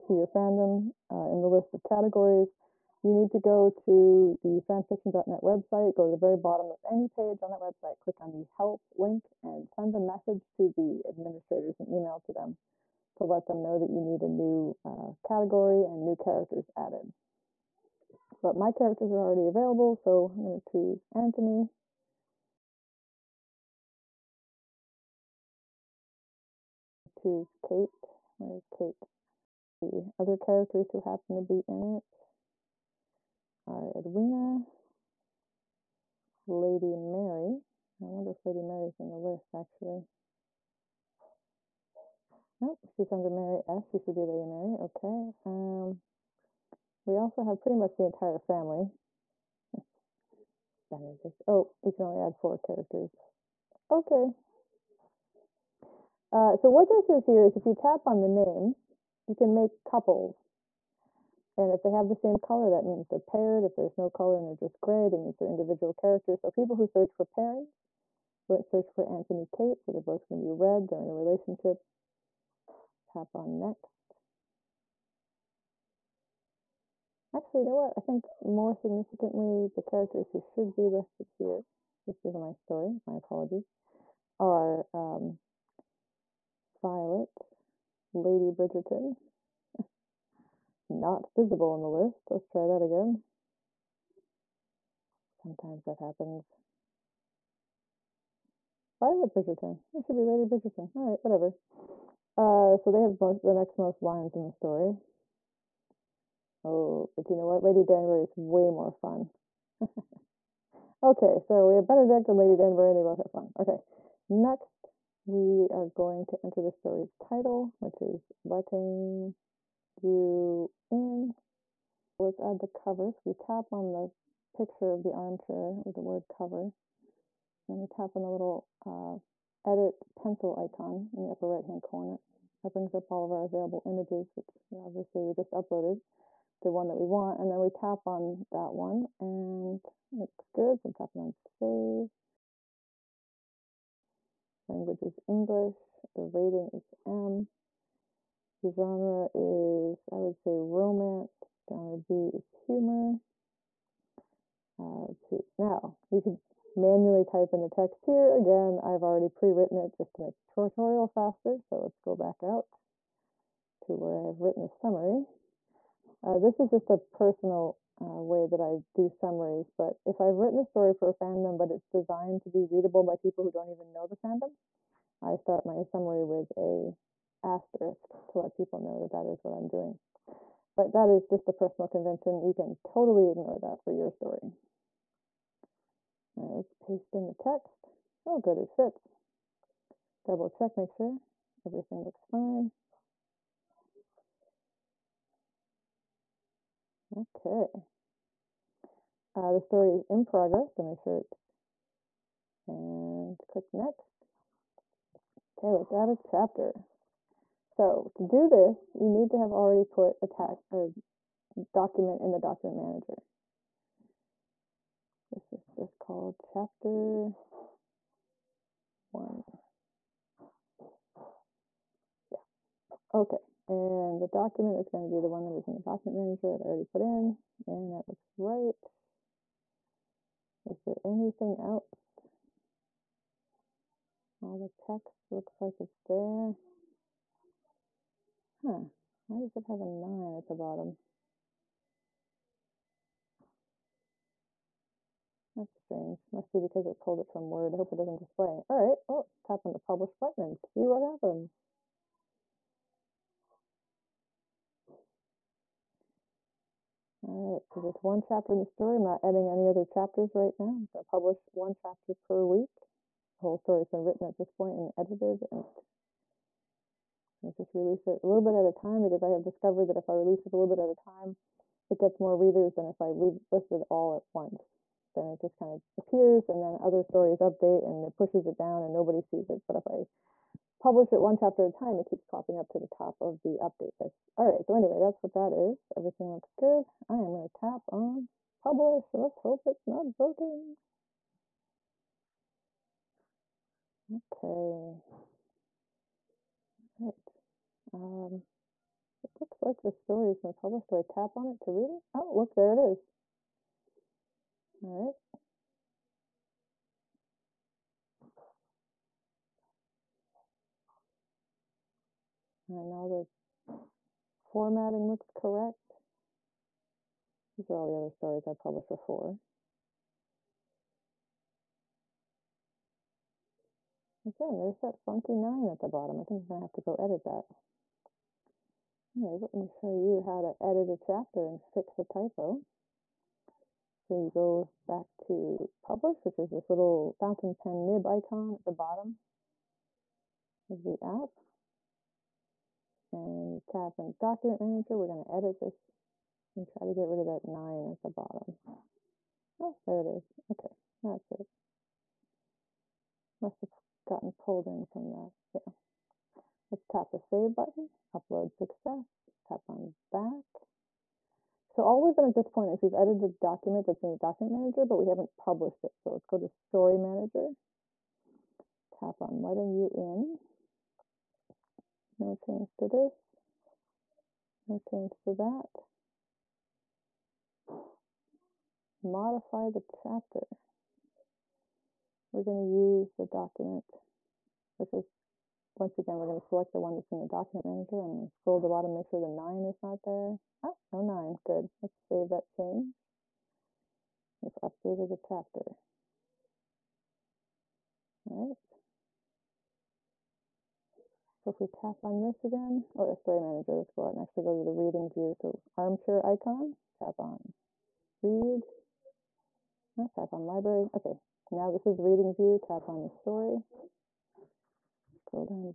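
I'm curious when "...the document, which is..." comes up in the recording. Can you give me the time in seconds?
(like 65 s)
383 s.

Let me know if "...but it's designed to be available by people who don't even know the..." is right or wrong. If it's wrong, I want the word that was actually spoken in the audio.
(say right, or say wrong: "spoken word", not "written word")
wrong: "readable", not "available".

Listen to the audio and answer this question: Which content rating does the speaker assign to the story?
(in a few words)
M.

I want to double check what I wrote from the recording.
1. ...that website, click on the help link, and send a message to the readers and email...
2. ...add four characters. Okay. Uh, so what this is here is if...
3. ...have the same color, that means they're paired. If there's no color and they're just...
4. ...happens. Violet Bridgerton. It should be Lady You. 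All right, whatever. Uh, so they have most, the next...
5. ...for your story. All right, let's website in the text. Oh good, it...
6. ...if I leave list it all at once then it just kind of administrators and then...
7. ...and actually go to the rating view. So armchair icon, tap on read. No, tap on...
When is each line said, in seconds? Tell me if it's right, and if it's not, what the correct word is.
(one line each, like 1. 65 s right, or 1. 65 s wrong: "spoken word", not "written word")
1. 7 s wrong: "administrators", not "readers"
2. 52 s right
3. 61 s right
4. 95 s wrong: "Bridgerton", not "You"
5. 183 s wrong: "paste", not "website"
6. 272 s wrong: "appears", not "administrators"
7. 404 s wrong: "reading", not "rating".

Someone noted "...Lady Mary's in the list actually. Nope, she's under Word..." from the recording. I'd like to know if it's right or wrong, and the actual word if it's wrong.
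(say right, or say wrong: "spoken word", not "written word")
wrong: "Mary", not "Word".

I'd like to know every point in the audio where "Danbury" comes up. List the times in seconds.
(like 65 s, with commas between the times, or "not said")
107 s, 112 s.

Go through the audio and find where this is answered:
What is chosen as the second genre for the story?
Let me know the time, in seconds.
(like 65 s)
152 s.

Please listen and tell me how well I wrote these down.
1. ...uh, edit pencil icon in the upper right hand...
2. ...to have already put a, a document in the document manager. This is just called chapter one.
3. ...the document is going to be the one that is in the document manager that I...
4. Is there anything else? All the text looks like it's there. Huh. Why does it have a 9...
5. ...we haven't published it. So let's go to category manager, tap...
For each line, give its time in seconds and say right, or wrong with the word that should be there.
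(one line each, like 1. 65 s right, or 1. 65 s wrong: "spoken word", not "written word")
1. 128 s right
2. 209 s right
3. 224 s right
4. 230 s right
5. 364 s wrong: "story", not "category".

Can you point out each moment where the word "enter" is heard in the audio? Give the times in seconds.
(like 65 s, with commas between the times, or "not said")
116 s.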